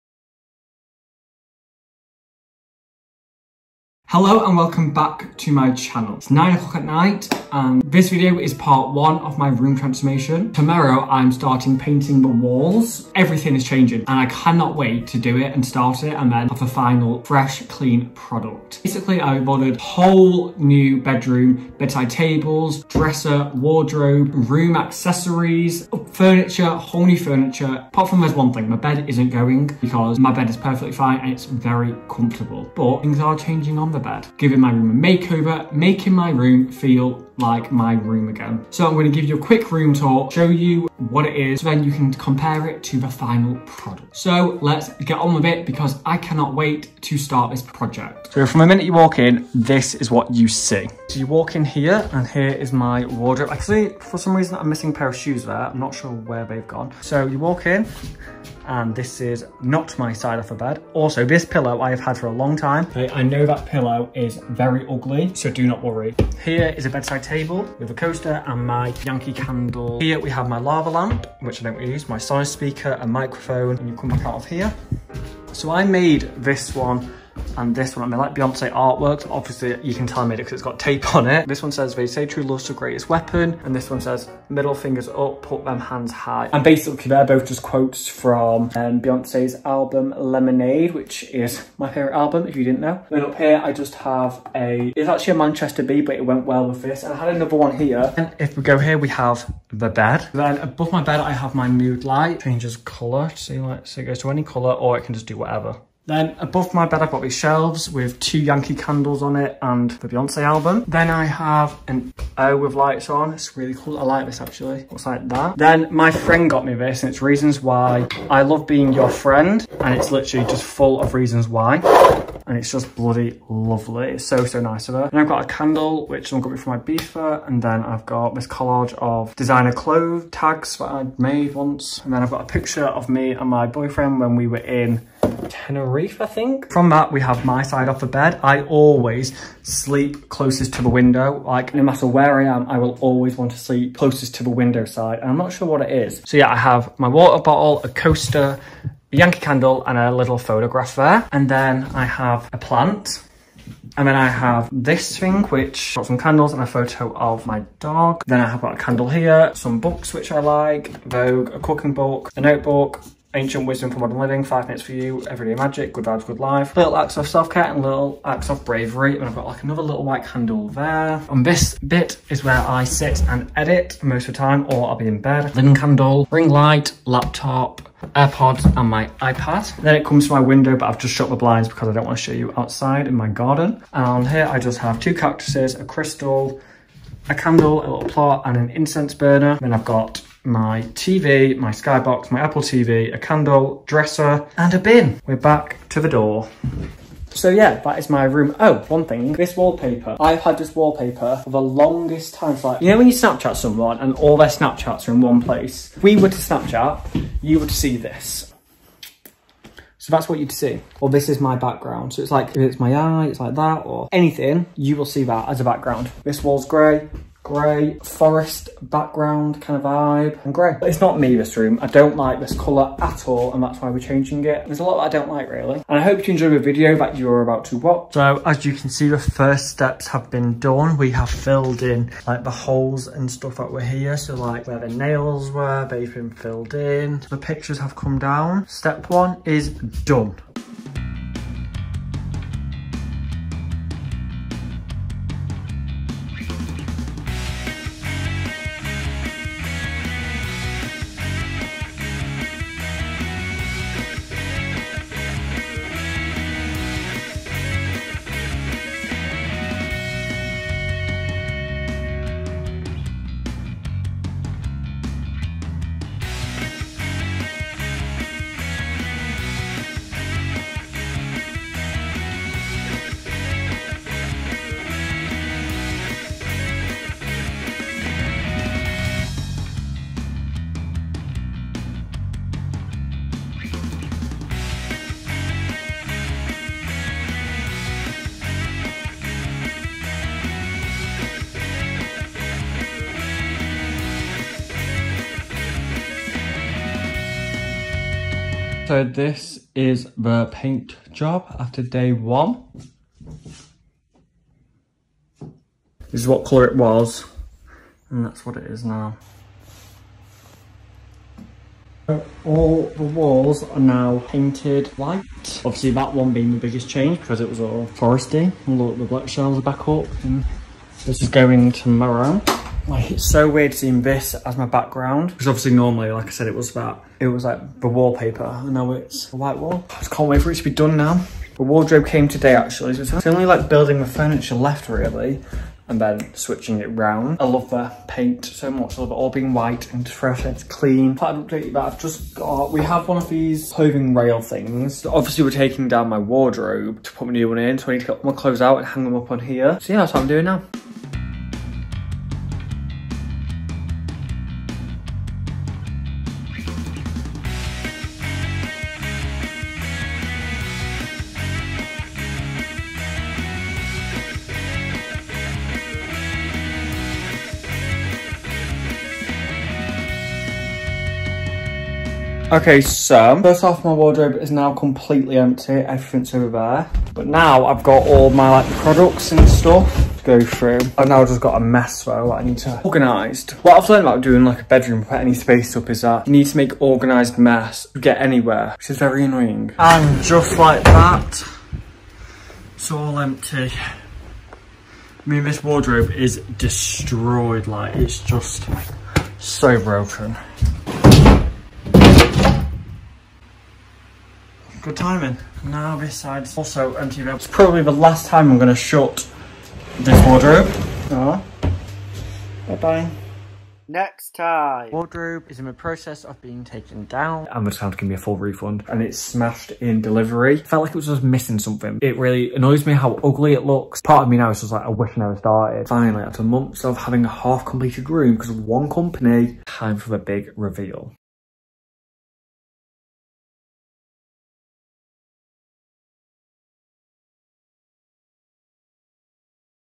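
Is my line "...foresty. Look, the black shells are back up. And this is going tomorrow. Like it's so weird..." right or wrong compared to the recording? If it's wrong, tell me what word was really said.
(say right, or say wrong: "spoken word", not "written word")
right.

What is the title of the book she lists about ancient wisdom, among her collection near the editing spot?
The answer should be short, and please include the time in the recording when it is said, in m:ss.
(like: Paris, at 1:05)
Ancient Wisdom for Modern Living, at 2:43.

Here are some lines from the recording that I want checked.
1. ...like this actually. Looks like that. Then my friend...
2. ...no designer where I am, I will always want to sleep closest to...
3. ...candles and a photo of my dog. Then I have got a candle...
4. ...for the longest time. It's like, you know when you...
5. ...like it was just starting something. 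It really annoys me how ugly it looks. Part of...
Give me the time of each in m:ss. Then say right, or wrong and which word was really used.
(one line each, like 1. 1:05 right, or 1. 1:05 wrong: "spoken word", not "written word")
1. 1:54 right
2. 2:21 wrong: "matter", not "designer"
3. 2:36 right
4. 3:21 right
5. 7:00 wrong: "missing", not "starting".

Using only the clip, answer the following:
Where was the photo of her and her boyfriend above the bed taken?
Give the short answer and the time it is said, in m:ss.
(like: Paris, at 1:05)
Tenerife, at 2:15.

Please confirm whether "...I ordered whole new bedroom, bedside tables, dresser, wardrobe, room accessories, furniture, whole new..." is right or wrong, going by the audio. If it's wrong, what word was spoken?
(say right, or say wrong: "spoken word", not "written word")
right.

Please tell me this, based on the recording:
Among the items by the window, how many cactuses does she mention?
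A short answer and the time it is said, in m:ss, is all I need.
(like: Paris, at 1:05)
2, at 3:04.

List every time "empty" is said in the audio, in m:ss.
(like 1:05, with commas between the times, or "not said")
6:15, 6:33, 6:46.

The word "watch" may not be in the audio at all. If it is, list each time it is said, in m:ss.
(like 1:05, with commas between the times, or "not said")
3:47.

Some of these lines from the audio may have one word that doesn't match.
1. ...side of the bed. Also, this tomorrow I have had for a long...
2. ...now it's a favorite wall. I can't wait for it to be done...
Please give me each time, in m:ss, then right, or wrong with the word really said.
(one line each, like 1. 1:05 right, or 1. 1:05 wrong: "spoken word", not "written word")
1. 1:00 wrong: "pillow", not "tomorrow"
2. 5:28 wrong: "white", not "favorite".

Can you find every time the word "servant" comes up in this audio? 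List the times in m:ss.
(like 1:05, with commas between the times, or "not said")
not said.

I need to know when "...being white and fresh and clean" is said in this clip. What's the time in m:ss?
5:39.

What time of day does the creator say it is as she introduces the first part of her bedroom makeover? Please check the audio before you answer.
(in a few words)
9 o'clock at night.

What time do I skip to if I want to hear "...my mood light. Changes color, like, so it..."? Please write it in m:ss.
1:41.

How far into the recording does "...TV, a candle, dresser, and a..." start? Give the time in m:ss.
3:12.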